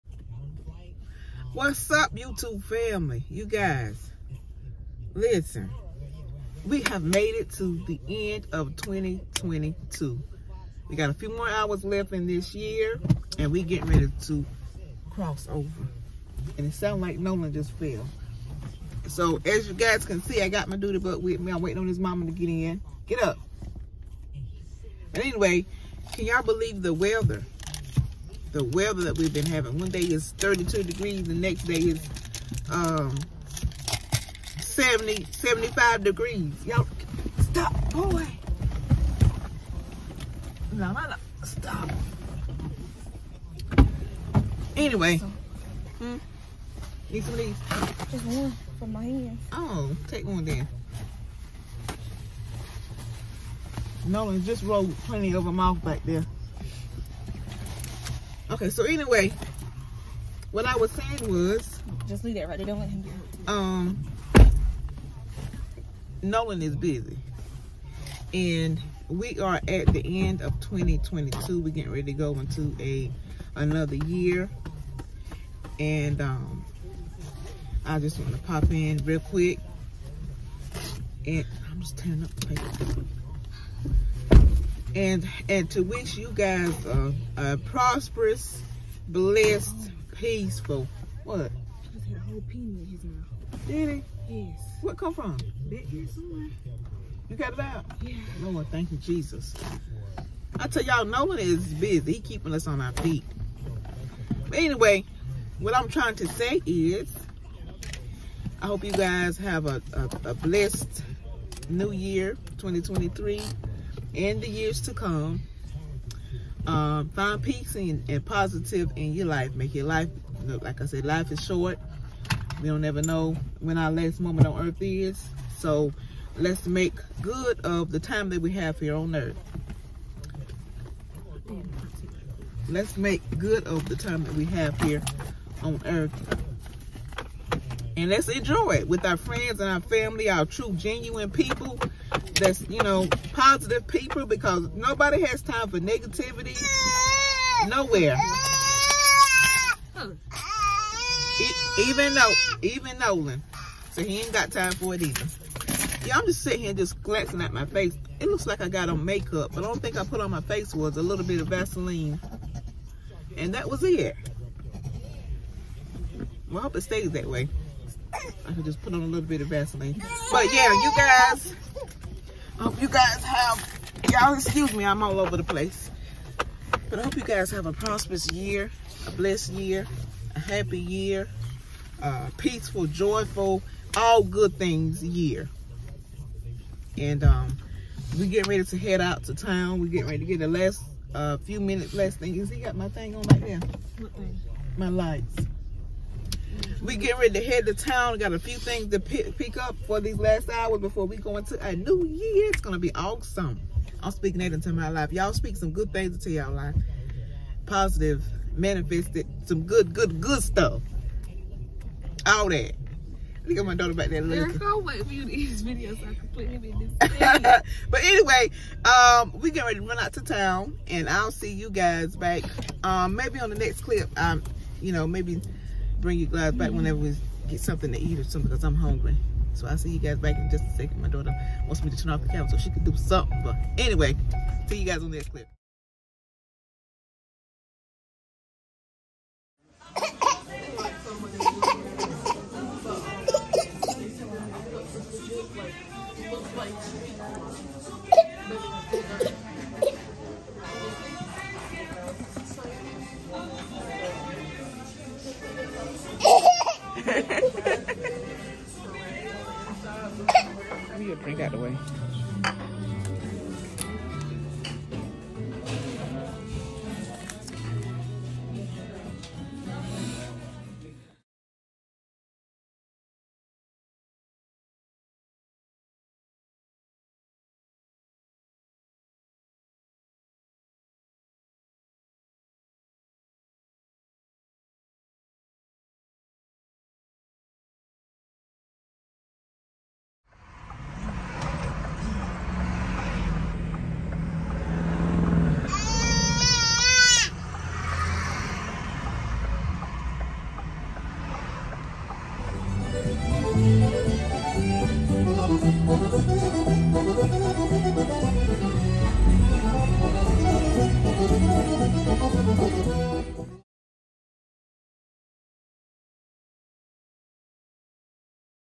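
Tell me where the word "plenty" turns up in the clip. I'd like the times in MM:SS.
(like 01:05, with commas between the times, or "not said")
00:54.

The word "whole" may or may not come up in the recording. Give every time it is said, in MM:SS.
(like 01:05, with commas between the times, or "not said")
01:32.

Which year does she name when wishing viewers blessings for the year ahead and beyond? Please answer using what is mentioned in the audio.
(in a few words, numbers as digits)
2023.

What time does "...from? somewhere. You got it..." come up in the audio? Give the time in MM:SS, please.
01:35.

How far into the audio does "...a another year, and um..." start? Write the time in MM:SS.
01:12.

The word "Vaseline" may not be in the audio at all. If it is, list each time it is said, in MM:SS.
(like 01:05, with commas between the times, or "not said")
02:41, 02:49.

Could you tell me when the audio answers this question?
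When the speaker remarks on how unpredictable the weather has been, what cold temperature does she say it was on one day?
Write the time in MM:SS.
00:30.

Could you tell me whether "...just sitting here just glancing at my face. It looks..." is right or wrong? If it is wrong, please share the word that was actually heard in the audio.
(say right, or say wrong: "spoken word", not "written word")
right.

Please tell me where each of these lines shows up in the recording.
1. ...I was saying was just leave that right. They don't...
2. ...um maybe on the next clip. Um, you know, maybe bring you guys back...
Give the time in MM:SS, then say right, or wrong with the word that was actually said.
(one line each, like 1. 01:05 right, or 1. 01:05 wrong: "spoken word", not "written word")
1. 01:00 right
2. 03:42 right.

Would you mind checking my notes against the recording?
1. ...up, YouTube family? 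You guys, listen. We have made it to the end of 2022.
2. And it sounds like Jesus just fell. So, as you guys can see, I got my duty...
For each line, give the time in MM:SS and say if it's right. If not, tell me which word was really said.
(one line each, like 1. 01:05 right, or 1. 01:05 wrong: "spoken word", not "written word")
1. 00:01 right
2. 00:16 wrong: "Nolan", not "Jesus".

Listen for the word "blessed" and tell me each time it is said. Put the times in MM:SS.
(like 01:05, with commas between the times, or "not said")
01:29, 01:50, 02:59.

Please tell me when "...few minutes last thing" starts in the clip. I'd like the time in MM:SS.
03:11.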